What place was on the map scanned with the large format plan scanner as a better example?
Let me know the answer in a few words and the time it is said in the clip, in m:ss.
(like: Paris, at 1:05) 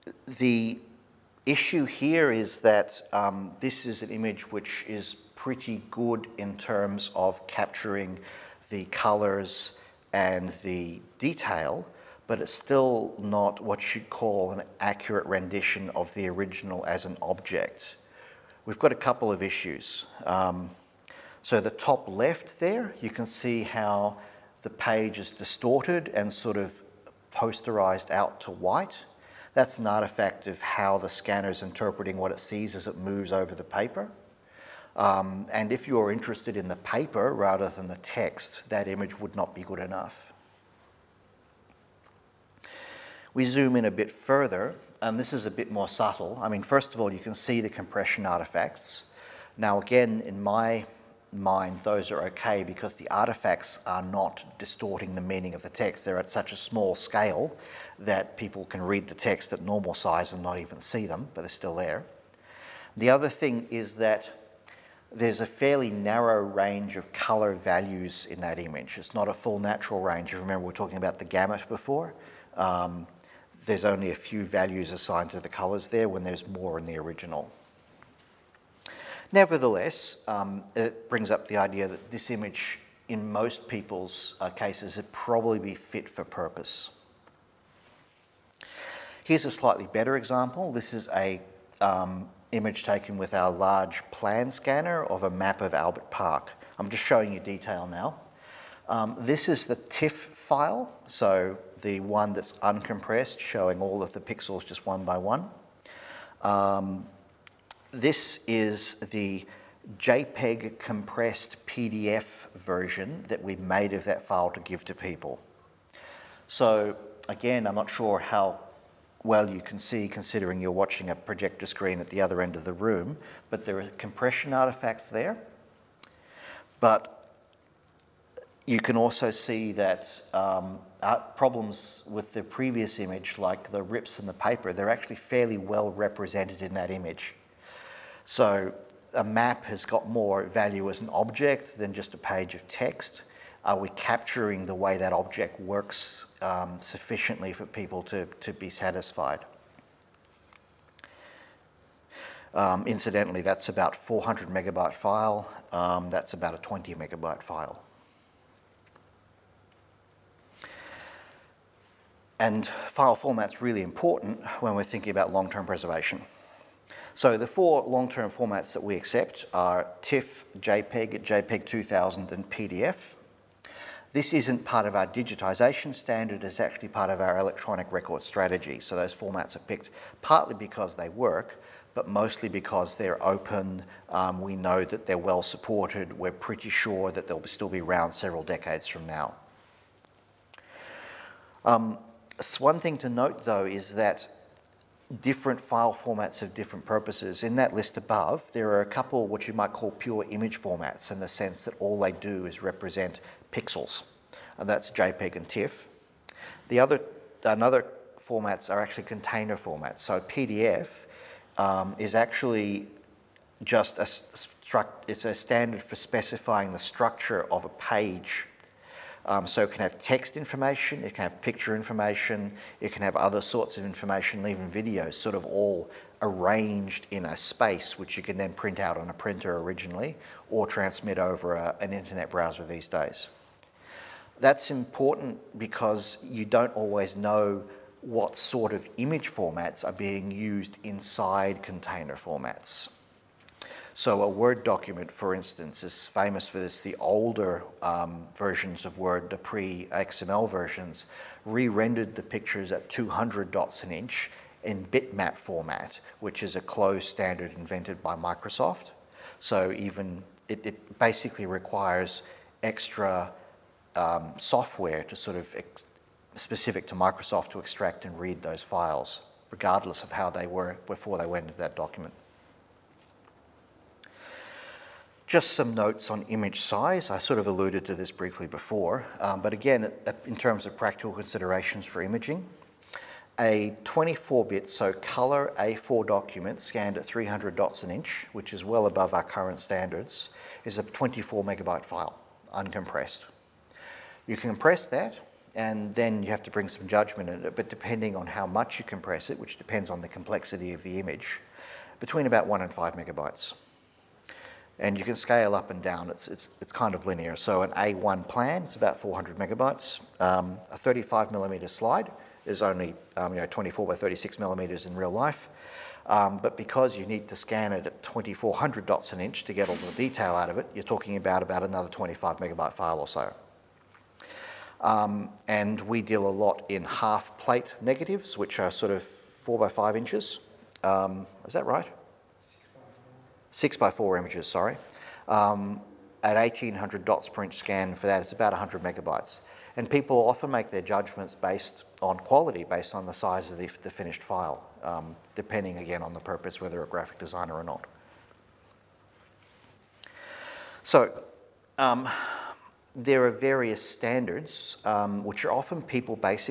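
Albert Park, at 1:35.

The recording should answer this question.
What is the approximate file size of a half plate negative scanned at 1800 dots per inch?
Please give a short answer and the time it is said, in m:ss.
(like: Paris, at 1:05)
100 megabytes, at 5:38.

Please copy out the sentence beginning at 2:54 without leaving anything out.
This isn't part of our digitization standard, it's actually part of our electronic record strategy.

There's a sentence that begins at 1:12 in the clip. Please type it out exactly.
Um, there's only a few values assigned to the colors there when there's more in the original.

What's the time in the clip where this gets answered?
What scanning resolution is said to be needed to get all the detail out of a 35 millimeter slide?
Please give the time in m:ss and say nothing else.
5:18.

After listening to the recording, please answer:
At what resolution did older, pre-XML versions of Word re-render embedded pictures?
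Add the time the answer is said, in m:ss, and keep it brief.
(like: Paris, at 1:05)
200 dots an inch, at 4:12.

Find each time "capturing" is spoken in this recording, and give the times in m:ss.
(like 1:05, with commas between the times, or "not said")
0:07, 2:23.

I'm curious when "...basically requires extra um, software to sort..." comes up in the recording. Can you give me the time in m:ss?
4:20.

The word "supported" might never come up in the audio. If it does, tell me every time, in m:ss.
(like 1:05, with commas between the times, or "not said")
3:05.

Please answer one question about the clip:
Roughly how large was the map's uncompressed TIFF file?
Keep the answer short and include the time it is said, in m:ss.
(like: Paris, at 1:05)
400 megabytes, at 2:33.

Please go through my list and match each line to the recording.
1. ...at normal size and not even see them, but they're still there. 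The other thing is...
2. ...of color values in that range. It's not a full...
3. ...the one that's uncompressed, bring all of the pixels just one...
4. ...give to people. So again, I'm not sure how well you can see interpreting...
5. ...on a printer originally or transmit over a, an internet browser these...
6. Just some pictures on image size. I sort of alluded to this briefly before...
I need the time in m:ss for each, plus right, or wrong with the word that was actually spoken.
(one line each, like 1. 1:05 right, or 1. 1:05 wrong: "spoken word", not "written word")
1. 0:59 right
2. 1:06 wrong: "image", not "range"
3. 1:41 wrong: "showing", not "bring"
4. 1:54 wrong: "considering", not "interpreting"
5. 3:48 right
6. 4:35 wrong: "notes", not "pictures".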